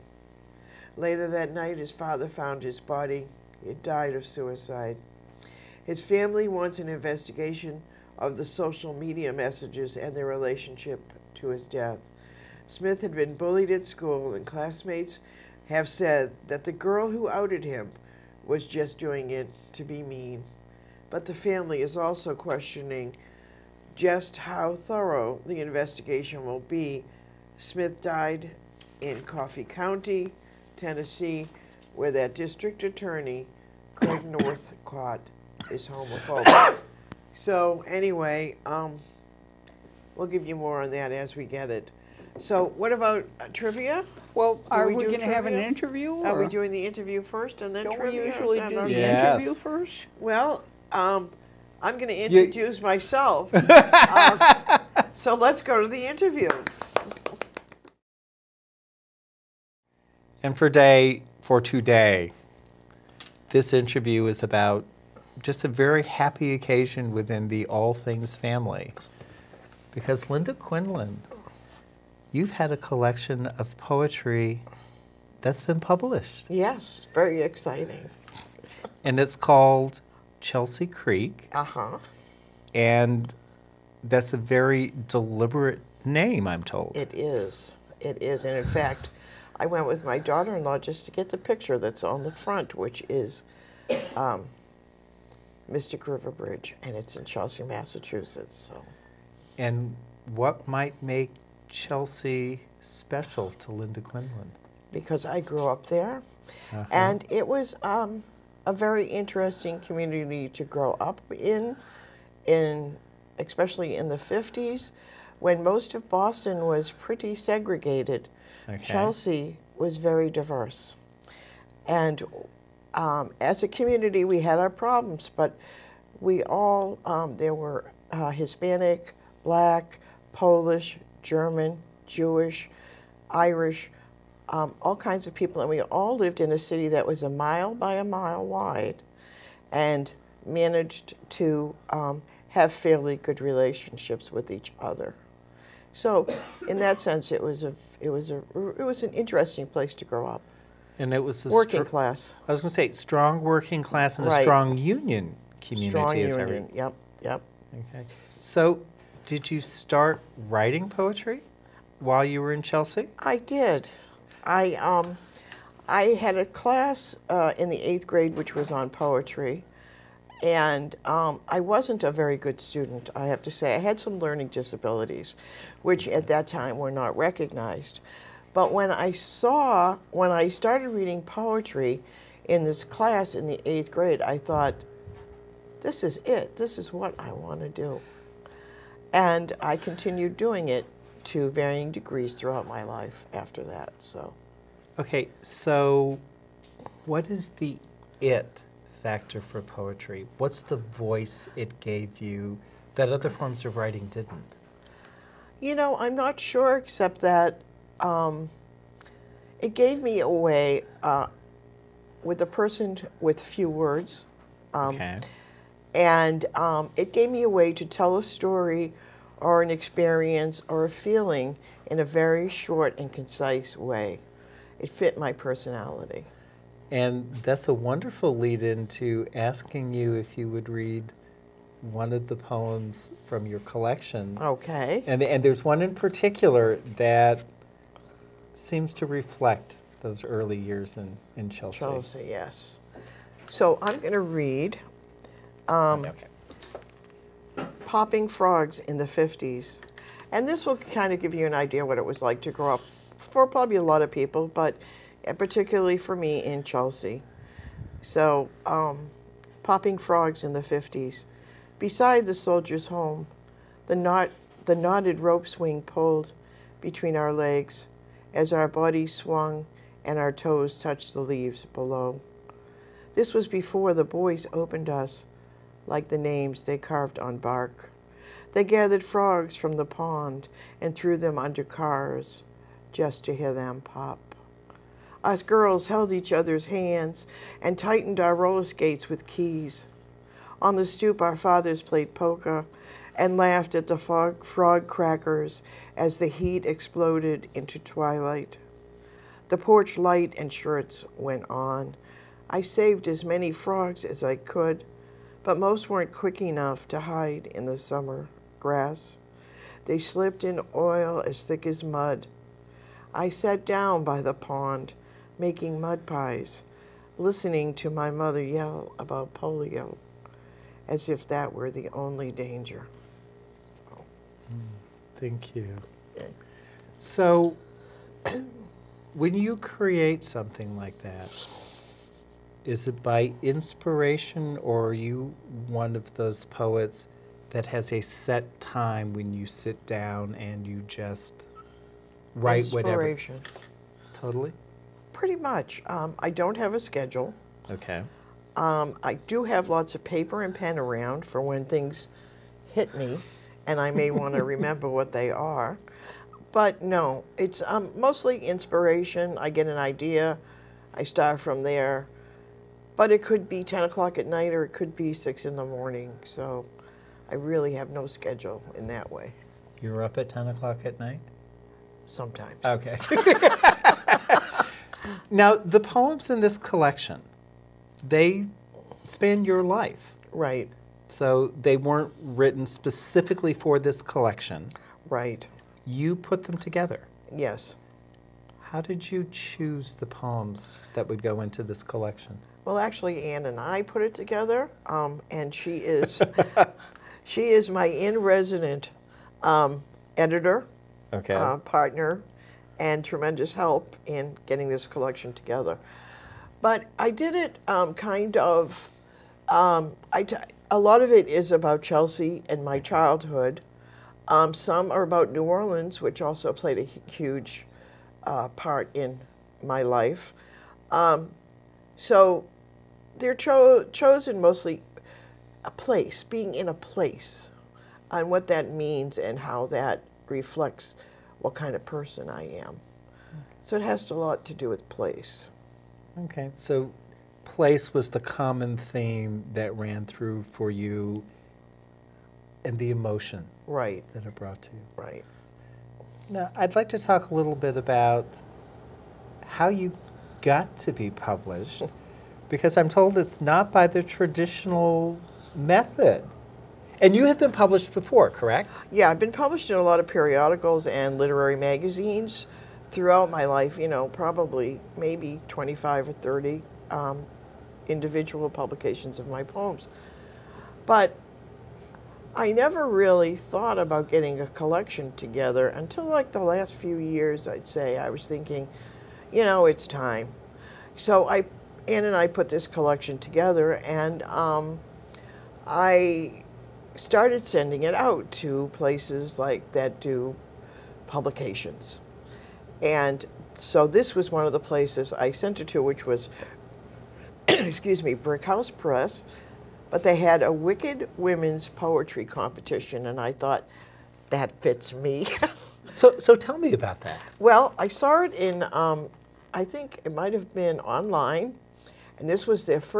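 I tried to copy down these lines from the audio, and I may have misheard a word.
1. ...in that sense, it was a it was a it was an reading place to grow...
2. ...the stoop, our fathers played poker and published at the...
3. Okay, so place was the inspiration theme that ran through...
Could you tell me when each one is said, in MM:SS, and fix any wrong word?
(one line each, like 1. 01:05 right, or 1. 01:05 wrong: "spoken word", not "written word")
1. 02:26 wrong: "interesting", not "reading"
2. 04:50 wrong: "laughed", not "published"
3. 07:16 wrong: "common", not "inspiration".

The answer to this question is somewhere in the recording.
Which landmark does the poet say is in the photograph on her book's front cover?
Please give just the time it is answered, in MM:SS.
01:35.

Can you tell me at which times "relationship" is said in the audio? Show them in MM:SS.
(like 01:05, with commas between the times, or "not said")
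00:10, 02:23.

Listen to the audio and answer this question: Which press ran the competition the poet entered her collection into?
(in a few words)
Brick House Press.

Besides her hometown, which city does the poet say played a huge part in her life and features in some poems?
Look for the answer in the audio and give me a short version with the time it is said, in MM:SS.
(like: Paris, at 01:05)
New Orleans, at 06:55.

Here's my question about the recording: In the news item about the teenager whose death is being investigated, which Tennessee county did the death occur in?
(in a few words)
Coffee County.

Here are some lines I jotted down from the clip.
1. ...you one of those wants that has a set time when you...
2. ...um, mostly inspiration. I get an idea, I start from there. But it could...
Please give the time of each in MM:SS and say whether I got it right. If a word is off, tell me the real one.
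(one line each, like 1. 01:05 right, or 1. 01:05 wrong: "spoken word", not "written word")
1. 05:34 wrong: "poets", not "wants"
2. 05:57 right.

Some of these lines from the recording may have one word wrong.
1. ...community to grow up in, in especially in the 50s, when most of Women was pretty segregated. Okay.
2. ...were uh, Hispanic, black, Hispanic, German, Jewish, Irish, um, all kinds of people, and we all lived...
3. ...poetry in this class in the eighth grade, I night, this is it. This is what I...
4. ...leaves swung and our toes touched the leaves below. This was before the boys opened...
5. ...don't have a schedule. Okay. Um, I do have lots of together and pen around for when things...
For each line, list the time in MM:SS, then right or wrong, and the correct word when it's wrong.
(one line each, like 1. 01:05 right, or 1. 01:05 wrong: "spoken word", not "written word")
1. 01:49 wrong: "Boston", not "Women"
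2. 02:07 wrong: "Polish", not "Hispanic"
3. 03:01 wrong: "thought", not "night"
4. 04:28 wrong: "bodies", not "leaves"
5. 05:46 wrong: "paper", not "together".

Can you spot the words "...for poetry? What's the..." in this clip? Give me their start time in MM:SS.
03:19.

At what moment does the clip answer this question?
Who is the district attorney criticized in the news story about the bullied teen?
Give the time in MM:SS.
00:34.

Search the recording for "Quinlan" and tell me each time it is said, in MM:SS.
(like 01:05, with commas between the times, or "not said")
01:10, 01:44.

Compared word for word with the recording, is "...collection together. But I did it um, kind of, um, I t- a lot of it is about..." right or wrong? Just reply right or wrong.
right.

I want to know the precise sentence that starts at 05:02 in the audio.
I saved as many frogs as I could, but most weren't quick enough to hide in the summer grass.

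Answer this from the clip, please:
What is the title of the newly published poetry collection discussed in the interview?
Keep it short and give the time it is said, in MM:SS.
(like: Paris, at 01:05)
Chelsea Creek, at 01:20.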